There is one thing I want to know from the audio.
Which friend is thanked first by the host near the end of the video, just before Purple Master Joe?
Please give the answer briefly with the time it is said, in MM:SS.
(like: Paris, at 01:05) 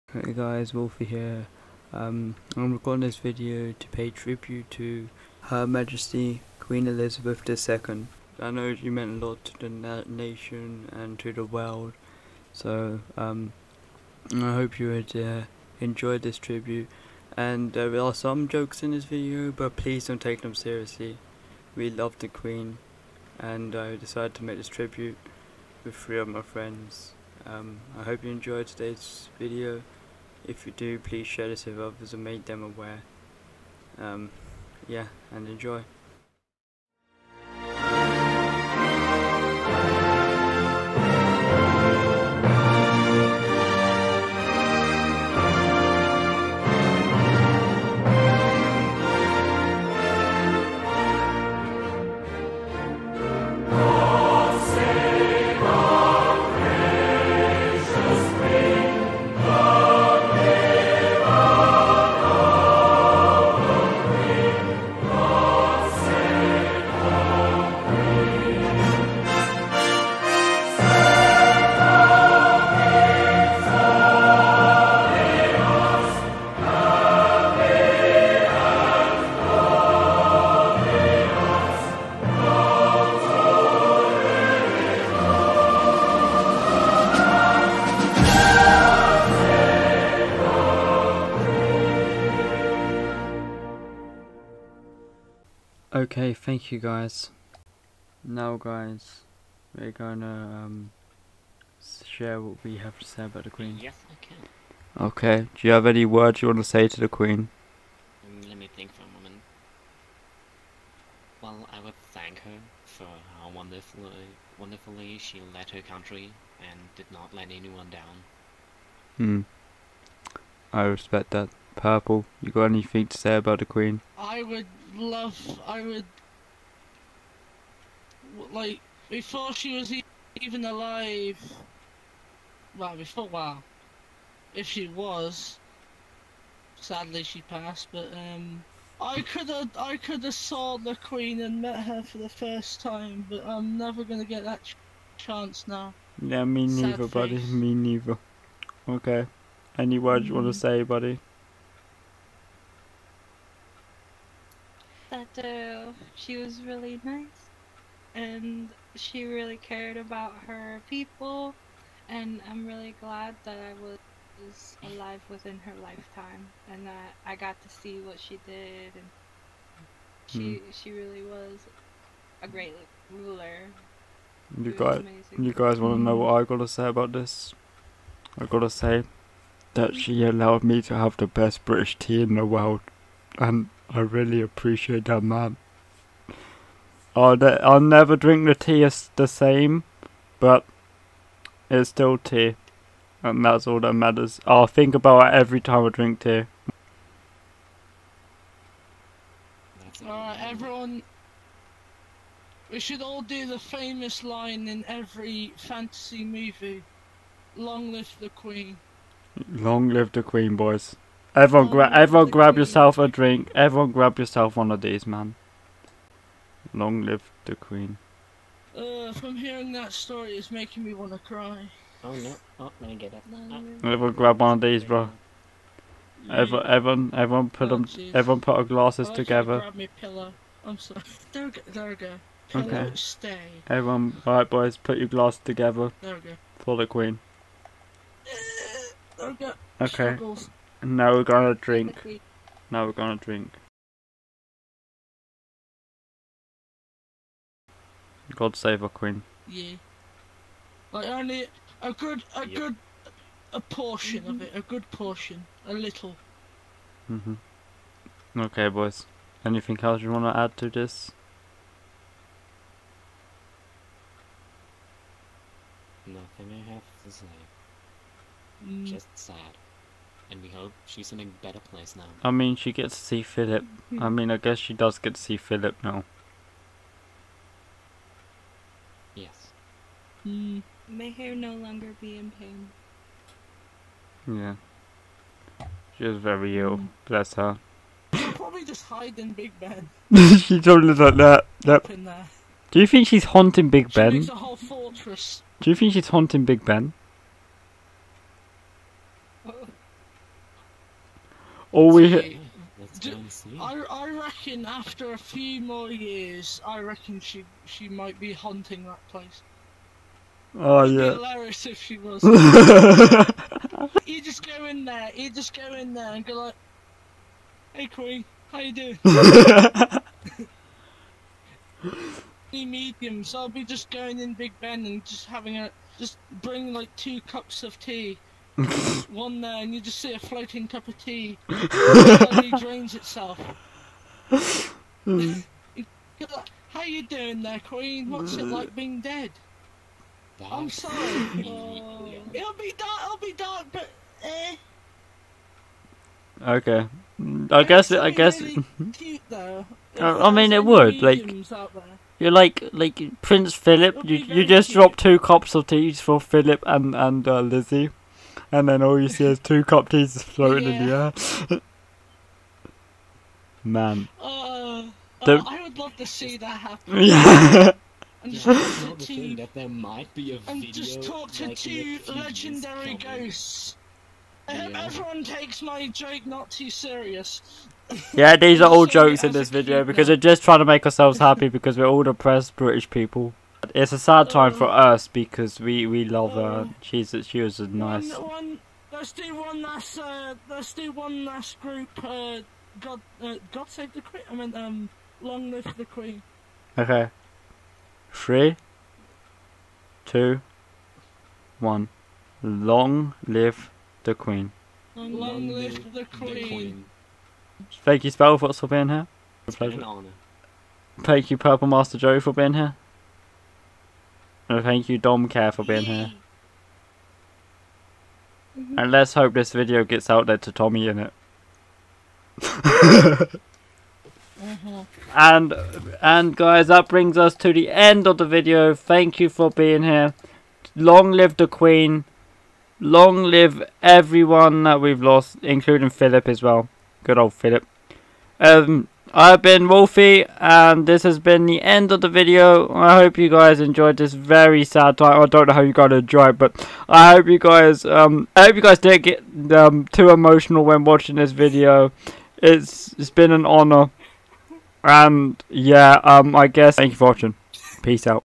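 Spell, at 06:48.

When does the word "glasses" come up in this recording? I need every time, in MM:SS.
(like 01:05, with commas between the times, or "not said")
03:48, 03:55.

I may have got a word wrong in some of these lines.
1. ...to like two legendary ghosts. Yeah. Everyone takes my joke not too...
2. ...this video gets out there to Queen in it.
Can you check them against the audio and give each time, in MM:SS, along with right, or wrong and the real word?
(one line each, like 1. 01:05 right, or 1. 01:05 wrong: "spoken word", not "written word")
1. 06:11 right
2. 06:59 wrong: "Tommy", not "Queen".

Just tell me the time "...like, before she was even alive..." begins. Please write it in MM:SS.
02:08.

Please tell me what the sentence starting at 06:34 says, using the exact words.
I mean, um, long live the Queen.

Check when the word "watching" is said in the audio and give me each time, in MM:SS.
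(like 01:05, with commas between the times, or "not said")
07:30, 07:37.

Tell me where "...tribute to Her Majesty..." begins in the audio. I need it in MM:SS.
00:04.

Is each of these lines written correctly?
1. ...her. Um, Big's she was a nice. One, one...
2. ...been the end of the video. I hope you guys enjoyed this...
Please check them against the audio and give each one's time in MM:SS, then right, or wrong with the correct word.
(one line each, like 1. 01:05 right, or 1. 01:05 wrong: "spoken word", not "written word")
1. 06:26 wrong: "She", not "Big"
2. 07:21 right.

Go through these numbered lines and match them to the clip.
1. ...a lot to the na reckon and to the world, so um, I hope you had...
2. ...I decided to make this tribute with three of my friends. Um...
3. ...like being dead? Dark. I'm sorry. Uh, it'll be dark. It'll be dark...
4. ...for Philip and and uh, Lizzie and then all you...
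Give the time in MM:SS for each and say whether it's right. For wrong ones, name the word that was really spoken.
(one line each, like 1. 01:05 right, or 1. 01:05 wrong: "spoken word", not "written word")
1. 00:09 wrong: "nation", not "reckon"
2. 00:23 right
3. 05:38 right
4. 05:55 right.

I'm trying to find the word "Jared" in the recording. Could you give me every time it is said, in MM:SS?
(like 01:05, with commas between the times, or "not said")
not said.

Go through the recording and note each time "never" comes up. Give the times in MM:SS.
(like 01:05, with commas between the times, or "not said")
02:23, 03:07.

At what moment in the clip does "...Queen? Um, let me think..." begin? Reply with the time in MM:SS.
01:47.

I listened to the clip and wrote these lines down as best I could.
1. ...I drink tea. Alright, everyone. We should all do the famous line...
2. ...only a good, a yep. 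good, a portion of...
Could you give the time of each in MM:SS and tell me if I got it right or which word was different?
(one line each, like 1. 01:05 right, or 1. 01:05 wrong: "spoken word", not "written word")
1. 03:15 right
2. 04:11 right.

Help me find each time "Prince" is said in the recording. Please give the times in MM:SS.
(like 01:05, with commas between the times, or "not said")
05:53.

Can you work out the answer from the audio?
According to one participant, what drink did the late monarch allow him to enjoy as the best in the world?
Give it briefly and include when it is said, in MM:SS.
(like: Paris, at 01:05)
British tea, at 03:01.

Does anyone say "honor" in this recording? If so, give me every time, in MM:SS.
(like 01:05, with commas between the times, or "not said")
06:49, 07:33.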